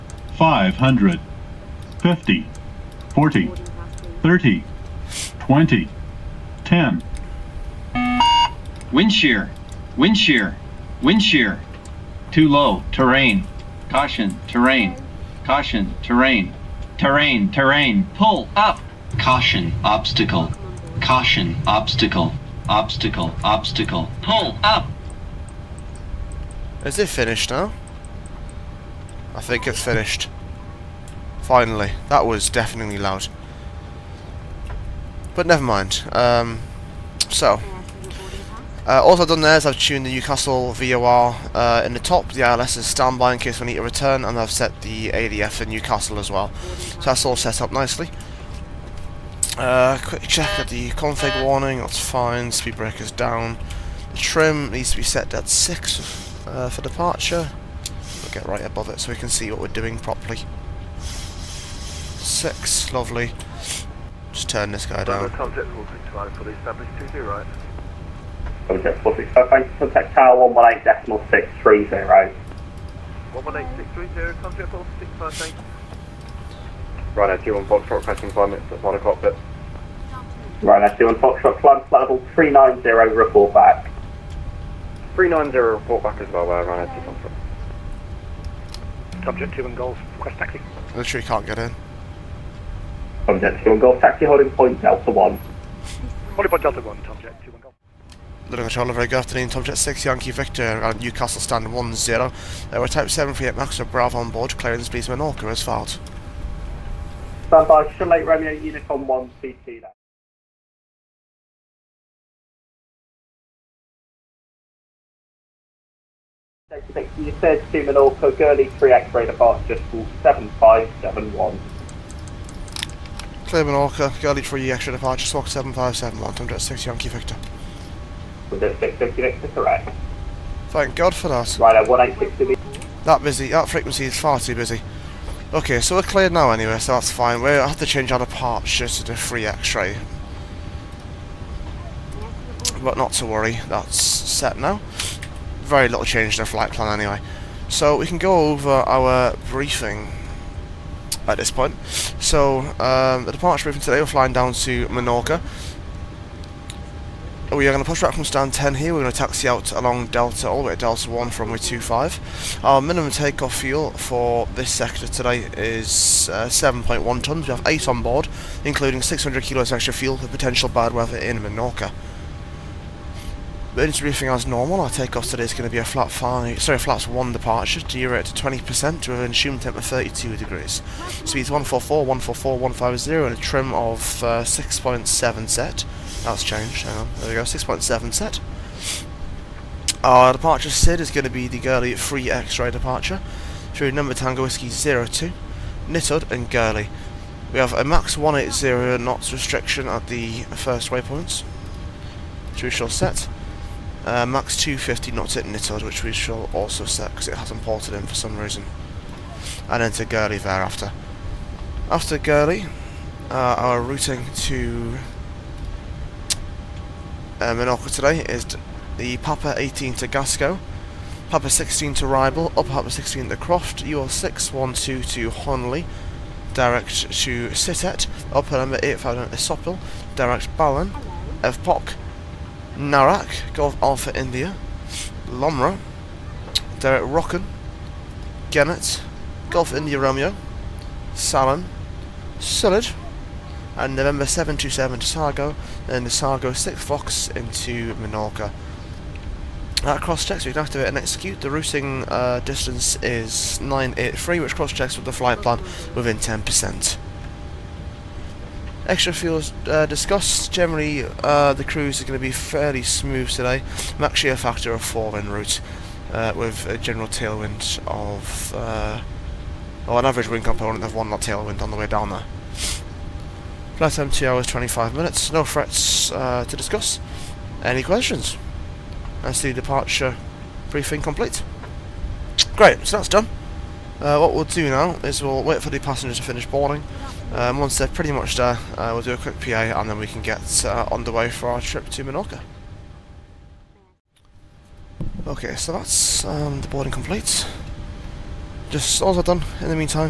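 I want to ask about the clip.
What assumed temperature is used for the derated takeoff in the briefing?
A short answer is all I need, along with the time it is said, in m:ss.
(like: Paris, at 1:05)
32 degrees, at 2:59.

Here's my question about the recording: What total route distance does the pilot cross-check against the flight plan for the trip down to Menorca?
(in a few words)
983.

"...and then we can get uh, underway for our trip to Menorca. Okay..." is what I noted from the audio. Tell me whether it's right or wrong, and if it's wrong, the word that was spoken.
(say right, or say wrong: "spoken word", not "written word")
right.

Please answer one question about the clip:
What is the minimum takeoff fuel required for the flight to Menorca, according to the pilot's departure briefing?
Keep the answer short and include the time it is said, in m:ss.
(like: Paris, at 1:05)
7.1 tonnes, at 2:46.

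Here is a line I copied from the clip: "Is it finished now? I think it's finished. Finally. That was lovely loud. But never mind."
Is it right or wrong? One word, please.
wrong.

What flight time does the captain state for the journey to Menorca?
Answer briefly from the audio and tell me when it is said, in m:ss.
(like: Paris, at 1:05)
2 hours 25 minutes, at 4:34.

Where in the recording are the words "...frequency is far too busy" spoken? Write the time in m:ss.
2:13.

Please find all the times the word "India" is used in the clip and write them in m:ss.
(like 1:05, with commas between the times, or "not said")
3:54, 3:59.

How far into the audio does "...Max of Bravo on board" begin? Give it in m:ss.
1:43.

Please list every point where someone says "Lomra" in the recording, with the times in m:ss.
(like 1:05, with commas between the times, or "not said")
3:55.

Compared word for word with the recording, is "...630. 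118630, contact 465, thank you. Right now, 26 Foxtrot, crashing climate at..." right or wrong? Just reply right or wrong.
wrong.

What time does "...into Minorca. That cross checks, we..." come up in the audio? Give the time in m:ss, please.
4:07.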